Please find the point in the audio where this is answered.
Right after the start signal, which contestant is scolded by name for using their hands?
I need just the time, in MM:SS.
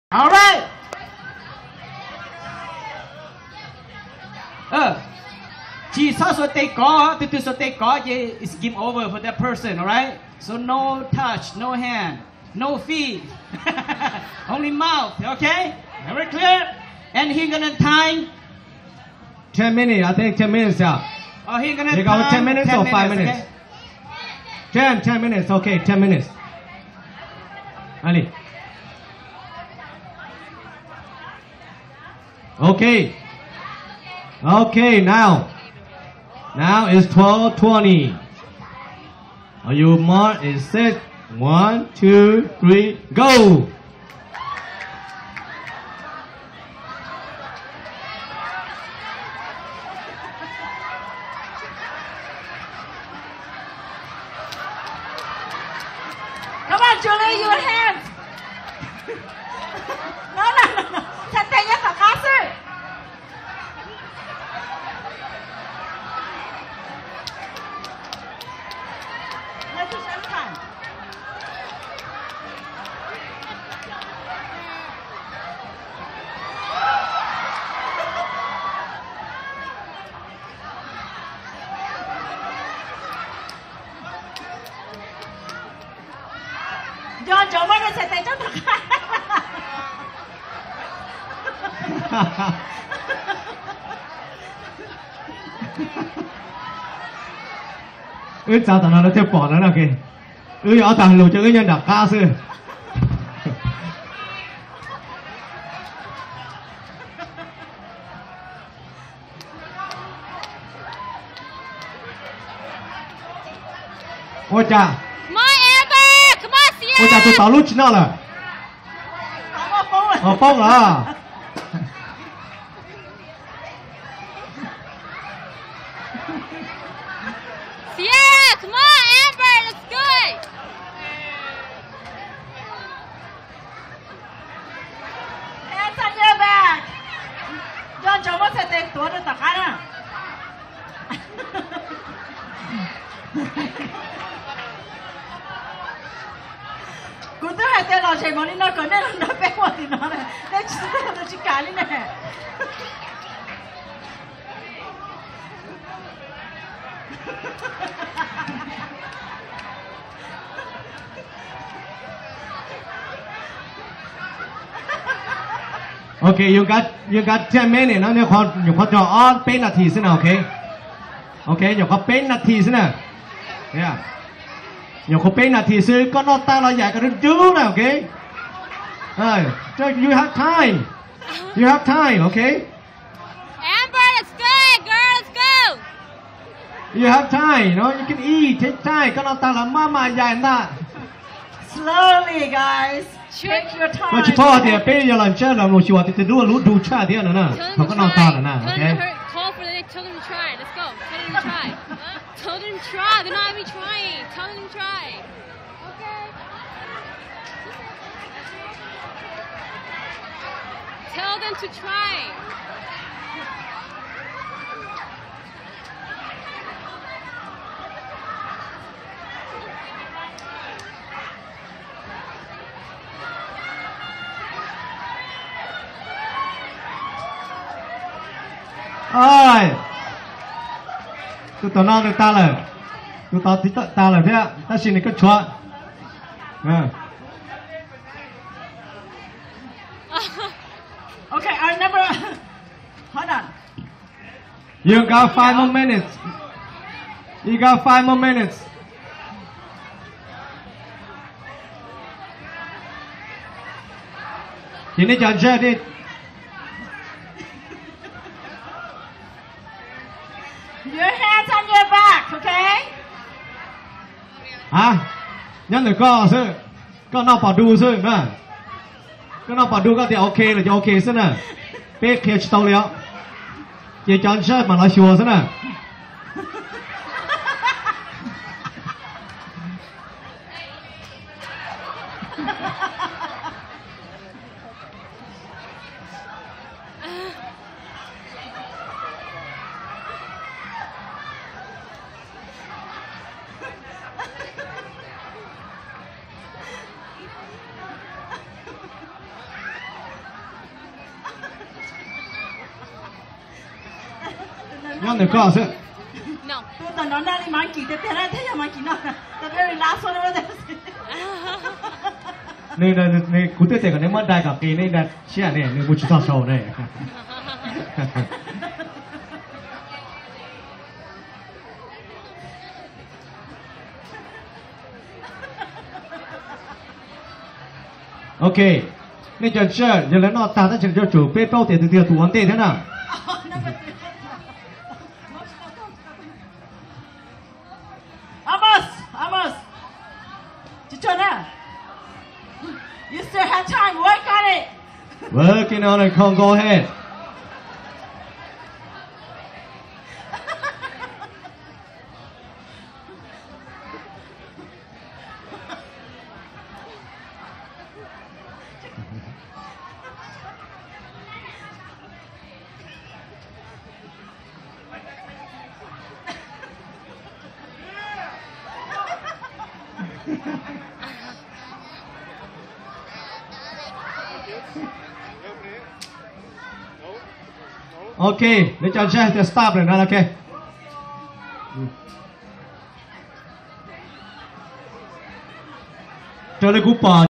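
00:57.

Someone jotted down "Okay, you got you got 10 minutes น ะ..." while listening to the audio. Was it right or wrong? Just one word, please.
right.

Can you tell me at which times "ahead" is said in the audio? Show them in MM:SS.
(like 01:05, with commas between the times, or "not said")
05:46.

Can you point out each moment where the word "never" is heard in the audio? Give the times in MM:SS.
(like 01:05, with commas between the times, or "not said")
04:01.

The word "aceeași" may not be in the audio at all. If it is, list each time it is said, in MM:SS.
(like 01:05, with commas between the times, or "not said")
06:18.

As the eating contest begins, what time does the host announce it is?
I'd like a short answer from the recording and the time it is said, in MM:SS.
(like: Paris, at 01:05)
12:20, at 00:37.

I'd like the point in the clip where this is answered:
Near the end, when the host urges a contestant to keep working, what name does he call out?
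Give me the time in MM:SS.
05:46.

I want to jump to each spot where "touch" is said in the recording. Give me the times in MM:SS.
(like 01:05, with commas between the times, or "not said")
00:11.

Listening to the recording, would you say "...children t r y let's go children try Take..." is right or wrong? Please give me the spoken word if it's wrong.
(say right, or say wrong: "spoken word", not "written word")
wrong: "Tell", not "Take".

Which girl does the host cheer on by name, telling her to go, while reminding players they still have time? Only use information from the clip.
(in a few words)
Amber.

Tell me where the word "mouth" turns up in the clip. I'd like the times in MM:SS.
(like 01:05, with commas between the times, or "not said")
00:14.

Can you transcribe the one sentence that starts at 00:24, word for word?
10, 10 minutes, okay, 10 minutes.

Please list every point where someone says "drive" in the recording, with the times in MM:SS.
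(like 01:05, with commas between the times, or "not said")
not said.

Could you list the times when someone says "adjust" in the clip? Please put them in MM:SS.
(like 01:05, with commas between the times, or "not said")
04:15.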